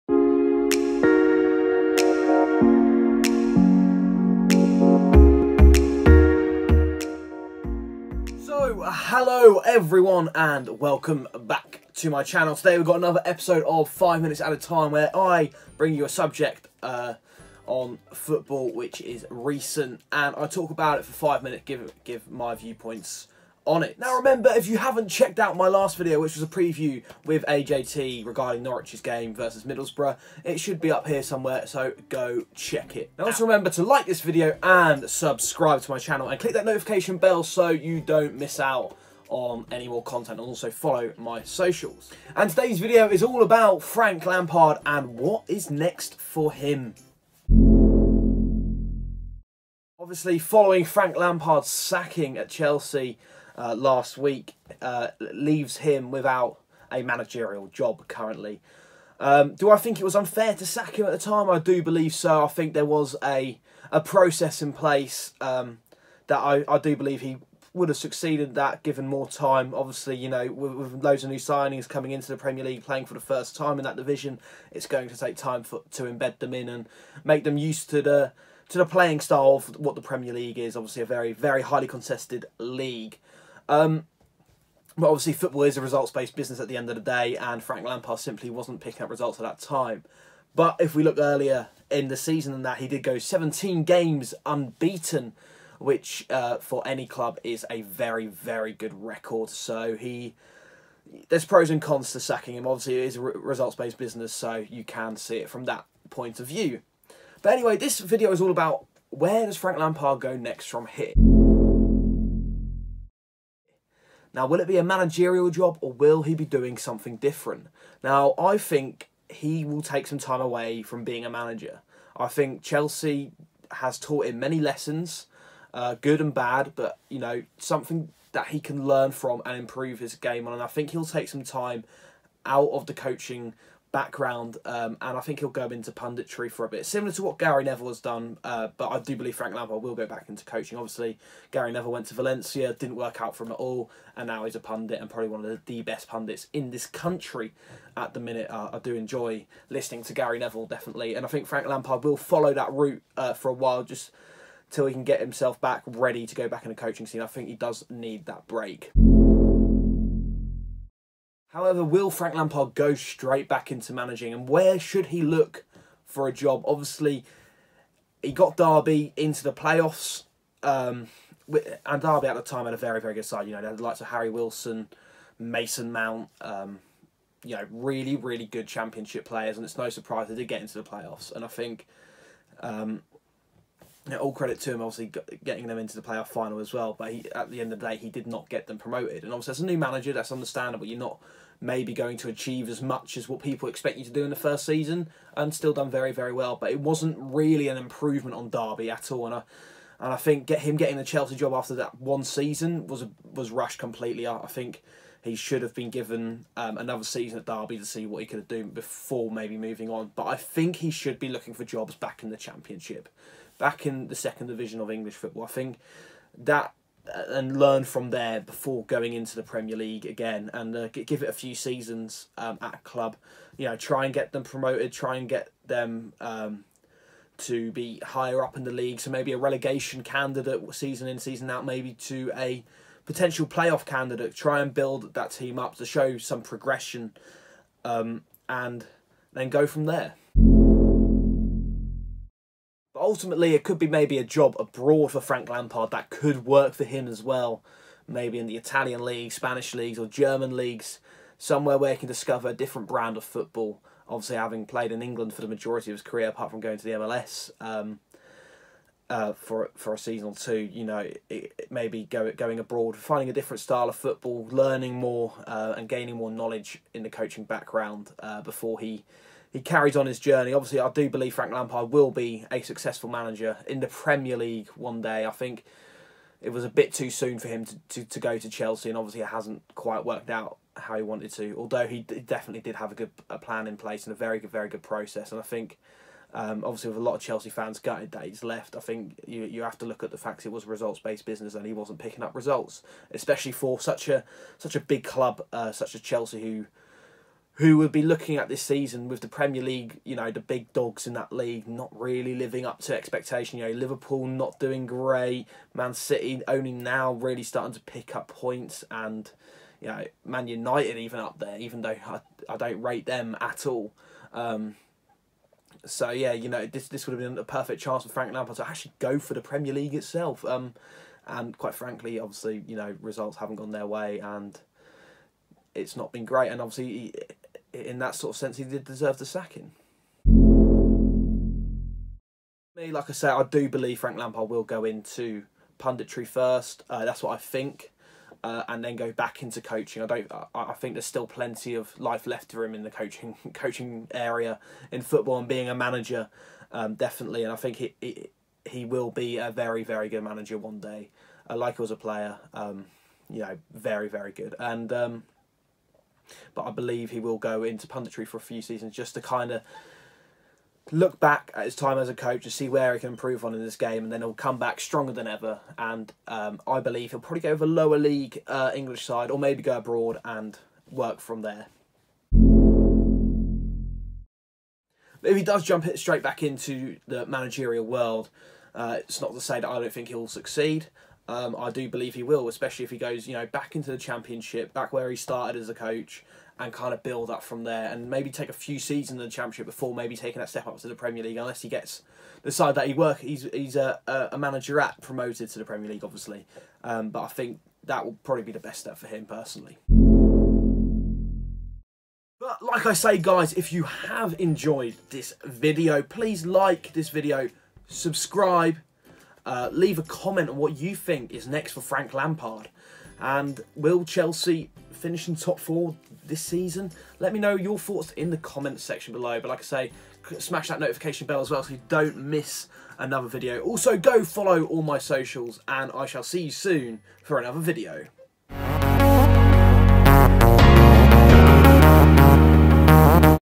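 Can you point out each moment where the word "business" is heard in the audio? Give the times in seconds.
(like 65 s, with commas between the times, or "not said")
86 s, 103 s, 291 s.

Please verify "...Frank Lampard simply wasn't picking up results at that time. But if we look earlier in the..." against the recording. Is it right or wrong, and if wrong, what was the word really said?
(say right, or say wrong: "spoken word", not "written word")
right.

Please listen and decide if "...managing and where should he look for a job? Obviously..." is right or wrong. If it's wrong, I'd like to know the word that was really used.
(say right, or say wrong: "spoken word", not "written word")
right.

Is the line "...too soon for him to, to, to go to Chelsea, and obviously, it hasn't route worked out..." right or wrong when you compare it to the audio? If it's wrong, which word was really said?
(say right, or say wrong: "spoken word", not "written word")
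wrong: "quite", not "route".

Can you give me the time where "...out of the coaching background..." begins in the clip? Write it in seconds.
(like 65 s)
132 s.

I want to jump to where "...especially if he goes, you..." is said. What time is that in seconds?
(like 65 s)
382 s.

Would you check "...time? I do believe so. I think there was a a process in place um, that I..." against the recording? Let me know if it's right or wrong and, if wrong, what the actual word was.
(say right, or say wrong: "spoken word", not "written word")
right.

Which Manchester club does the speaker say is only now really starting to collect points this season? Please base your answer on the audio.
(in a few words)
Man City.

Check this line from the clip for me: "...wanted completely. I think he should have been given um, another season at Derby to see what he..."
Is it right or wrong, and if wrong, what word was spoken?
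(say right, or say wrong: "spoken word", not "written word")
wrong: "rushed", not "wanted".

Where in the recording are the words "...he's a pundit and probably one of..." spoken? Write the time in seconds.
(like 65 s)
144 s.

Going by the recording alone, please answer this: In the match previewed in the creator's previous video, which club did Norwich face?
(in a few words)
Middlesbrough.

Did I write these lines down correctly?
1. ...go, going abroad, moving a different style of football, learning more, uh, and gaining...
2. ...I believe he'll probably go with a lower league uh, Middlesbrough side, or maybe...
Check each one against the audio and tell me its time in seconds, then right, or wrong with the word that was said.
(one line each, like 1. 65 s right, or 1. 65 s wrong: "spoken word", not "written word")
1. 262 s wrong: "finding", not "moving"
2. 366 s wrong: "English", not "Middlesbrough".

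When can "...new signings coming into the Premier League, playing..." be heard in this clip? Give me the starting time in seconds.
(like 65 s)
71 s.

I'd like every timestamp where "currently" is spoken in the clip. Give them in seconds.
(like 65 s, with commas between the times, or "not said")
58 s.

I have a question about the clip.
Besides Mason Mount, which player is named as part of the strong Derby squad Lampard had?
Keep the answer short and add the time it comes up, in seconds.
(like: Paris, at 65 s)
Harry Wilson, at 174 s.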